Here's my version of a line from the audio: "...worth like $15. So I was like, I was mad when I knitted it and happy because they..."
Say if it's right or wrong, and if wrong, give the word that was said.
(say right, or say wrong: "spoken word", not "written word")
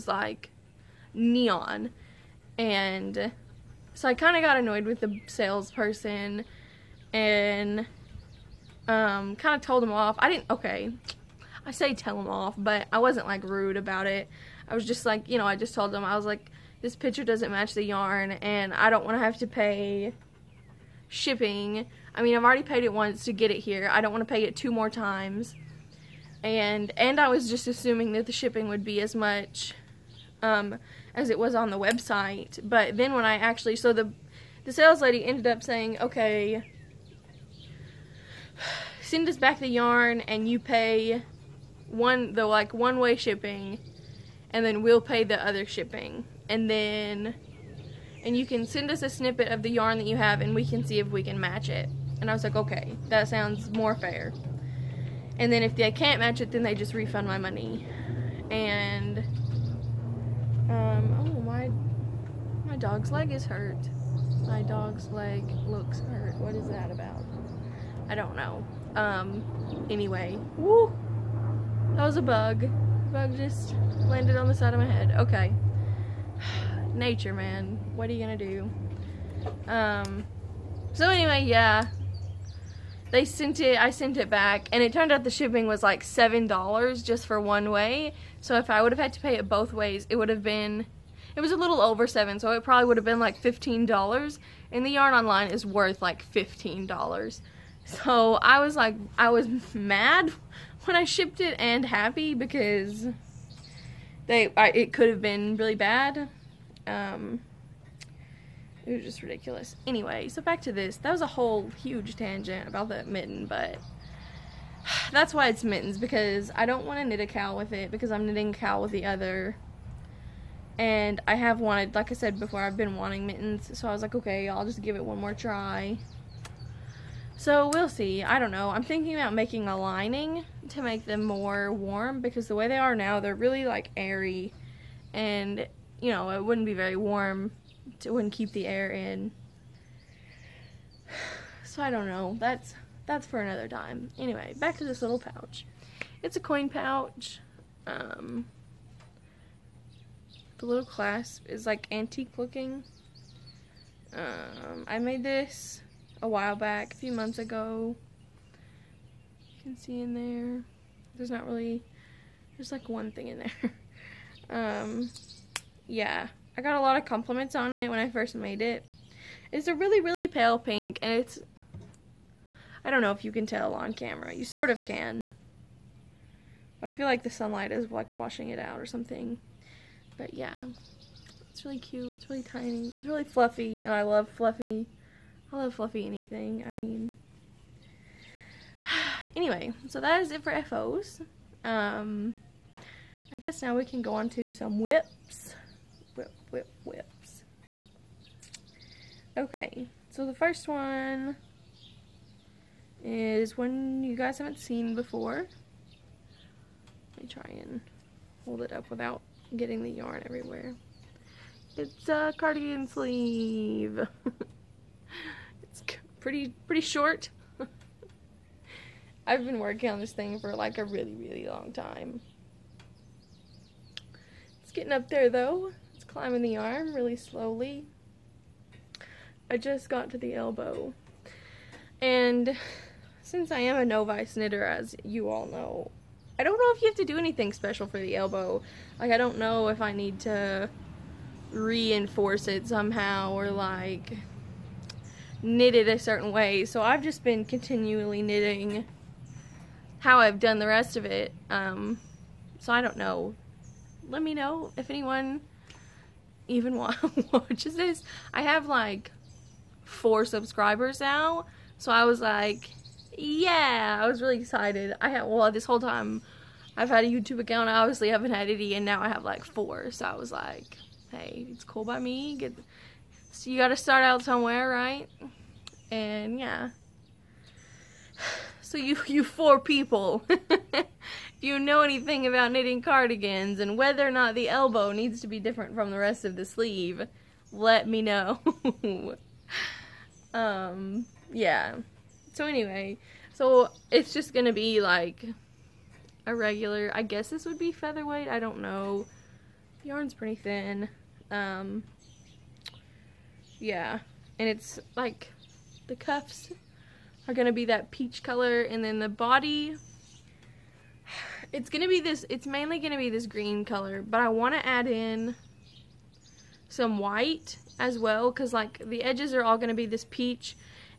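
wrong: "shipped", not "knitted".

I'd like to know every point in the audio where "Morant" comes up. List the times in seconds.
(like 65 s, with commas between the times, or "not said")
not said.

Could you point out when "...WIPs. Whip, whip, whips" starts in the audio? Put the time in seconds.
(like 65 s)
194 s.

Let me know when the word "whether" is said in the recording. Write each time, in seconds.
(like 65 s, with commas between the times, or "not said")
283 s.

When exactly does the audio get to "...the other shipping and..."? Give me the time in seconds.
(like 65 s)
45 s.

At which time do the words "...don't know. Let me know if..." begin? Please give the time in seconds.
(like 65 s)
252 s.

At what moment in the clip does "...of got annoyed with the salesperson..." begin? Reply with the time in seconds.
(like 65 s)
4 s.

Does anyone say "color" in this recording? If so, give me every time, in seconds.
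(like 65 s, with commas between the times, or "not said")
308 s, 313 s.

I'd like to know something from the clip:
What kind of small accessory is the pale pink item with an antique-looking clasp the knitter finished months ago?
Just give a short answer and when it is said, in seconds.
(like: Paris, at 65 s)
coin pouch, at 146 s.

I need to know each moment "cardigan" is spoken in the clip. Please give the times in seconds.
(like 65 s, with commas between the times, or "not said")
212 s, 282 s.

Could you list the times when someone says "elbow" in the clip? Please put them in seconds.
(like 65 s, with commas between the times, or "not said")
230 s, 238 s, 284 s.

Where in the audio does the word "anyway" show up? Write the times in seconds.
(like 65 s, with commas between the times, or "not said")
69 s, 81 s, 109 s, 144 s, 189 s, 292 s.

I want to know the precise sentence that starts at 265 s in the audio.
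I had, well, this whole time I've had a YouTube account.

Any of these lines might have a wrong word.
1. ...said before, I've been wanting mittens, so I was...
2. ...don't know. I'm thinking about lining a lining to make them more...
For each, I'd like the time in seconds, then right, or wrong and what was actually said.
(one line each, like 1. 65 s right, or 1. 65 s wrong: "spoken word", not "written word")
1. 122 s right
2. 128 s wrong: "making", not "lining".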